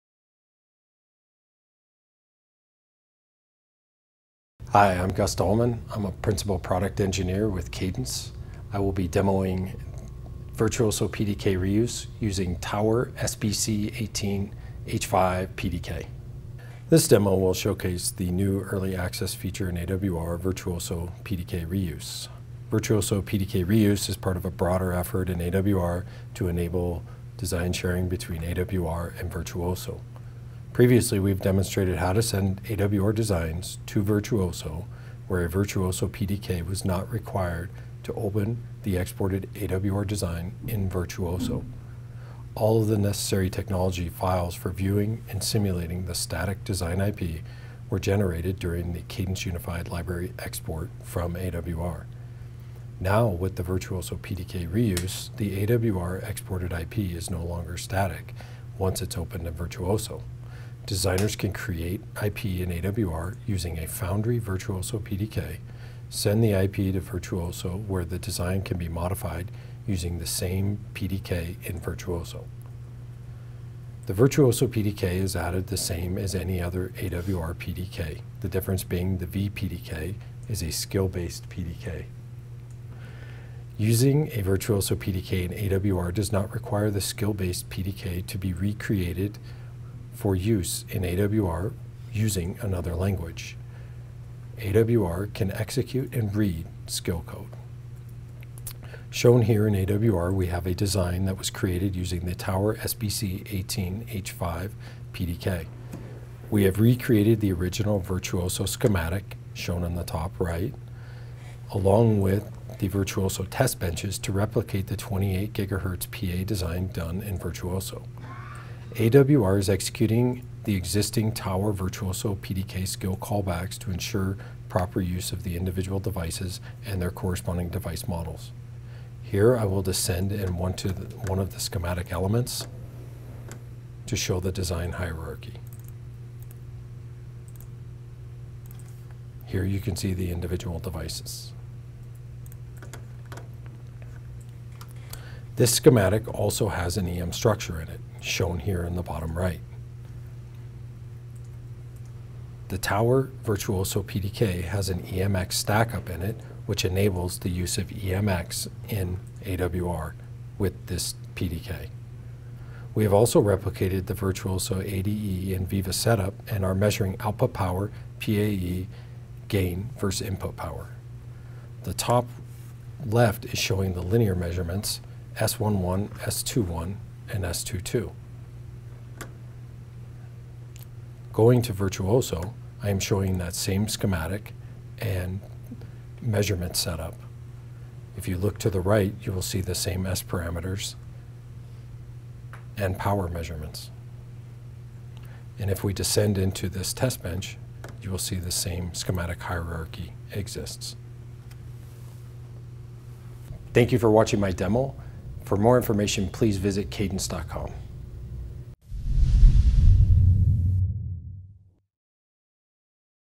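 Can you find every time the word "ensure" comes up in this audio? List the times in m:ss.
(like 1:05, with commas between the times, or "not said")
2:03.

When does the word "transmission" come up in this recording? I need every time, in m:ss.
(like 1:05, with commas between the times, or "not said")
not said.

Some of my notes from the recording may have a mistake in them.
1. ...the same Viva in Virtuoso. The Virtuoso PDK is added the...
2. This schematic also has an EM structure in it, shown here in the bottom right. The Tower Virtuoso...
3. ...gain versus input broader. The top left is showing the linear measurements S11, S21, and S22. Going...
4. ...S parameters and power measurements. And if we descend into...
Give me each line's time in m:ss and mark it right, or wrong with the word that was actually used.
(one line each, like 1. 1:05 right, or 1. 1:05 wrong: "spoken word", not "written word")
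1. 1:10 wrong: "PDK", not "Viva"
2. 2:25 right
3. 2:49 wrong: "power", not "broader"
4. 3:10 right.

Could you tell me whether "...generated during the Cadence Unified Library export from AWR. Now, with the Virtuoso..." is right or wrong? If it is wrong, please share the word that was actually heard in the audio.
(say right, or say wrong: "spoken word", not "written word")
right.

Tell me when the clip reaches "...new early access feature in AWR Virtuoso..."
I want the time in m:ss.
0:18.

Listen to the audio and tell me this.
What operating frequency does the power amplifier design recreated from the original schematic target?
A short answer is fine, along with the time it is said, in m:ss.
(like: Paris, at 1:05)
28 gigahertz, at 1:54.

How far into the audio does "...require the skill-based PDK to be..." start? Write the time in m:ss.
1:26.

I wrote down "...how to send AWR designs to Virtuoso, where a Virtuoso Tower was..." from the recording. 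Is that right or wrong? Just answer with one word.
wrong.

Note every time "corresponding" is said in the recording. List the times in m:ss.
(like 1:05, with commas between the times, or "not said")
2:07.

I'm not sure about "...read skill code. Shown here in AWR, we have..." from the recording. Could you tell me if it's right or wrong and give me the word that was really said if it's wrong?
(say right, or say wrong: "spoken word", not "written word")
right.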